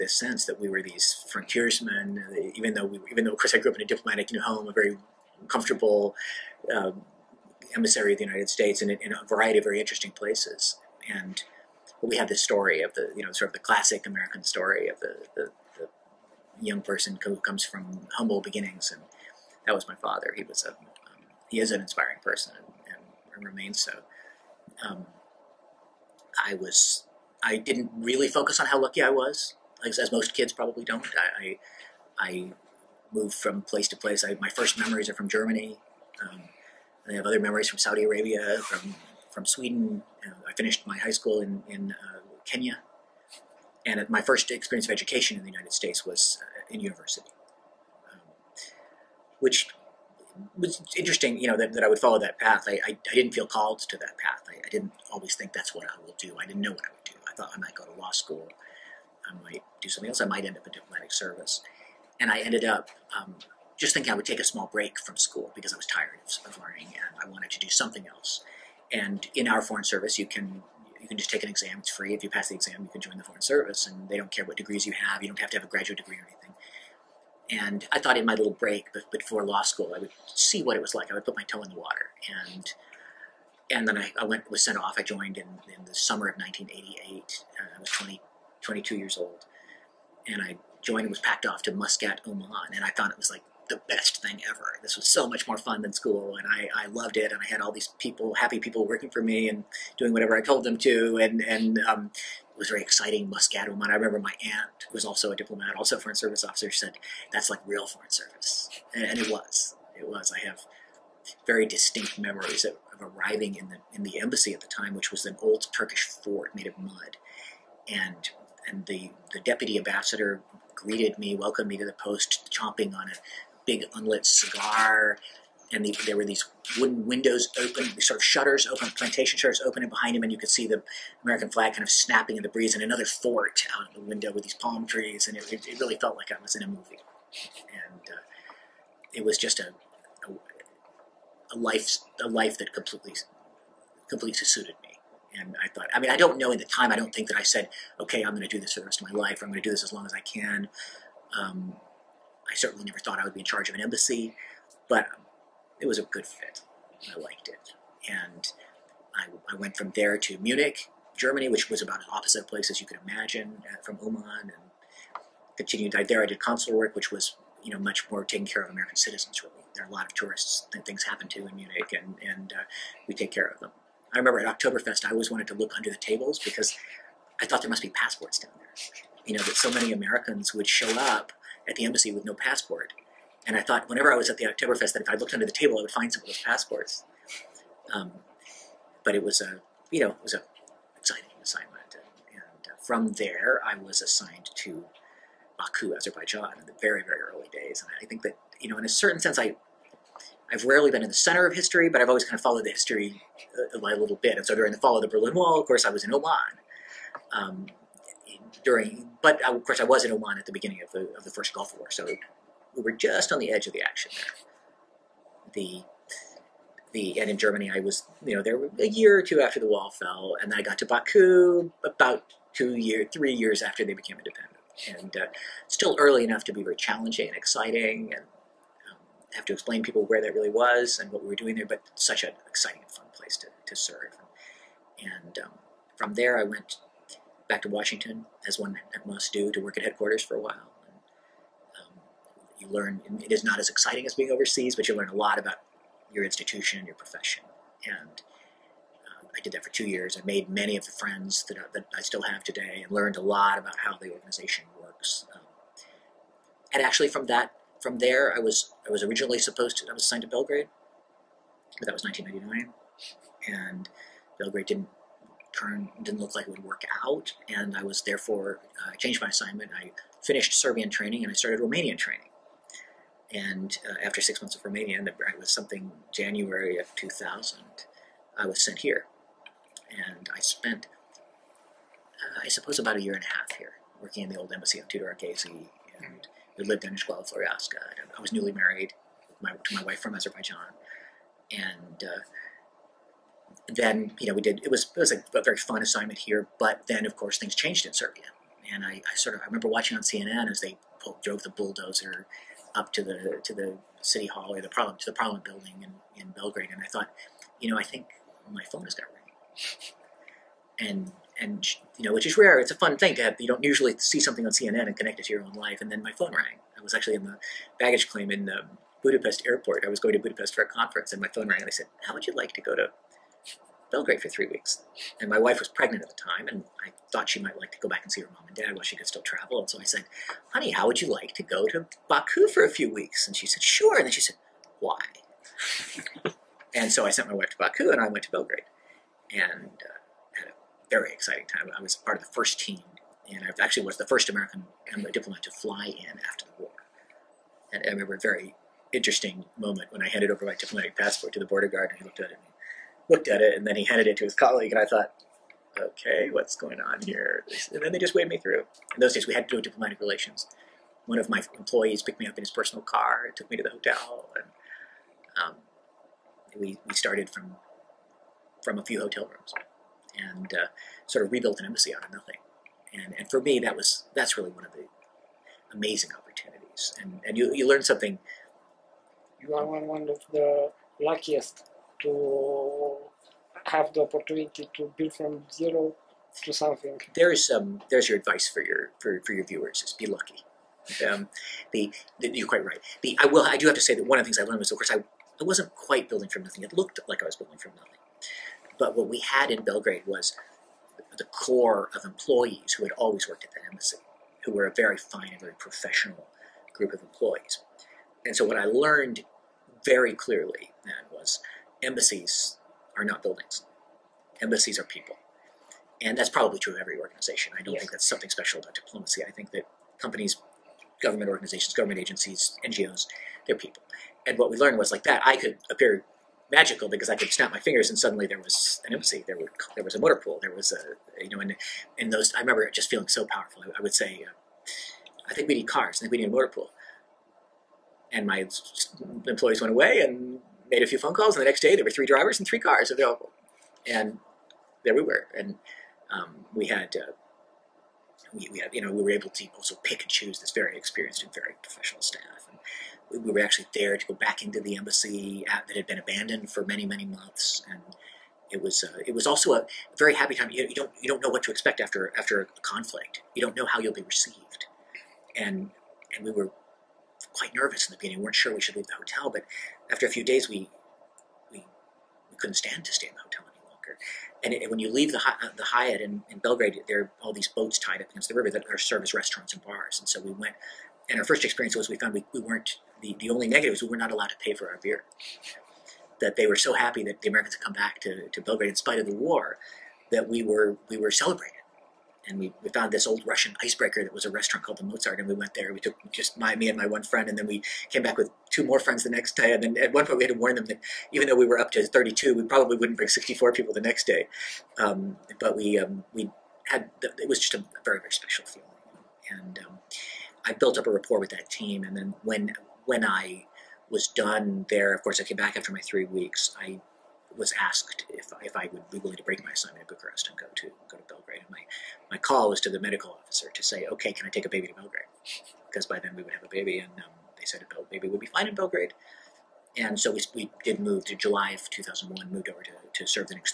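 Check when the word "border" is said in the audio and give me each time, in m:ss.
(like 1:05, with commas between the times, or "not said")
5:51.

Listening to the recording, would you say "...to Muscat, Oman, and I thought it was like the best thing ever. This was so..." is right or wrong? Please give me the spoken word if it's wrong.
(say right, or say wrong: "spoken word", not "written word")
right.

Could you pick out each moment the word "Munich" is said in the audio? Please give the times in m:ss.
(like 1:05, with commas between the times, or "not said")
2:40, 2:51.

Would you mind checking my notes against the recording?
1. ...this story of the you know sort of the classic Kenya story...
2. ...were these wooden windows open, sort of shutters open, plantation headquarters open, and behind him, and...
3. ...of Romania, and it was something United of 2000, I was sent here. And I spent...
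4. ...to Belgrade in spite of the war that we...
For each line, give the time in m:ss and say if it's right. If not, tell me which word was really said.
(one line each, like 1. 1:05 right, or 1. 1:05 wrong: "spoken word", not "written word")
1. 0:12 wrong: "American", not "Kenya"
2. 2:06 wrong: "shutters", not "headquarters"
3. 4:34 wrong: "January", not "United"
4. 8:08 right.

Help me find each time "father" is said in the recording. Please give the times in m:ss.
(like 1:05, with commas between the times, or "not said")
0:19.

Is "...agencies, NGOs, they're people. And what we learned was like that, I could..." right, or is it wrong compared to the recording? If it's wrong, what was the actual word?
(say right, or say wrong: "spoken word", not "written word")
right.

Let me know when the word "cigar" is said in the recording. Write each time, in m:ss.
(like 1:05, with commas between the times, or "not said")
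2:04.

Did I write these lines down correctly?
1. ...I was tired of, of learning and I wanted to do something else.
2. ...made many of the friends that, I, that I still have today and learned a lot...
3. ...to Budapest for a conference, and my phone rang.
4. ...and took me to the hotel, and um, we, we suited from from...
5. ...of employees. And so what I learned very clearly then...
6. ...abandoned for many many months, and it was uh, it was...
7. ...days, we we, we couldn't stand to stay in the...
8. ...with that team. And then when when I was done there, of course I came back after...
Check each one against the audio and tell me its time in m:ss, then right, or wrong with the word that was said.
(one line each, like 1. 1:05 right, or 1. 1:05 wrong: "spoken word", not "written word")
1. 1:05 right
2. 4:10 right
3. 5:20 right
4. 6:03 wrong: "started", not "suited"
5. 6:46 right
6. 7:35 right
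7. 7:50 right
8. 8:31 right.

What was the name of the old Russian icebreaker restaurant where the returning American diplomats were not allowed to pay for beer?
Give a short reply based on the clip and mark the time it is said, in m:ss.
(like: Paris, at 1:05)
Mozart, at 8:14.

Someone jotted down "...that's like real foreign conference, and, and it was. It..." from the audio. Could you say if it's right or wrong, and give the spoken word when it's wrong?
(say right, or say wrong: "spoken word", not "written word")
wrong: "service", not "conference".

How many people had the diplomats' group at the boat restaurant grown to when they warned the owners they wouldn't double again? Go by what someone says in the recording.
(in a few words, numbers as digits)
32.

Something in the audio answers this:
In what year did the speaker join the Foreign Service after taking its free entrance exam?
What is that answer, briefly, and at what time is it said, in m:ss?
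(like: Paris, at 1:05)
1988, at 1:26.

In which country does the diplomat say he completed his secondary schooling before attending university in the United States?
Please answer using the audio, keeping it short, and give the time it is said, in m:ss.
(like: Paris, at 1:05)
Kenya, at 0:42.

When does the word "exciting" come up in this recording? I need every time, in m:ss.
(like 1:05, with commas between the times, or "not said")
1:42, 3:10, 3:47, 3:52, 4:03, 5:41.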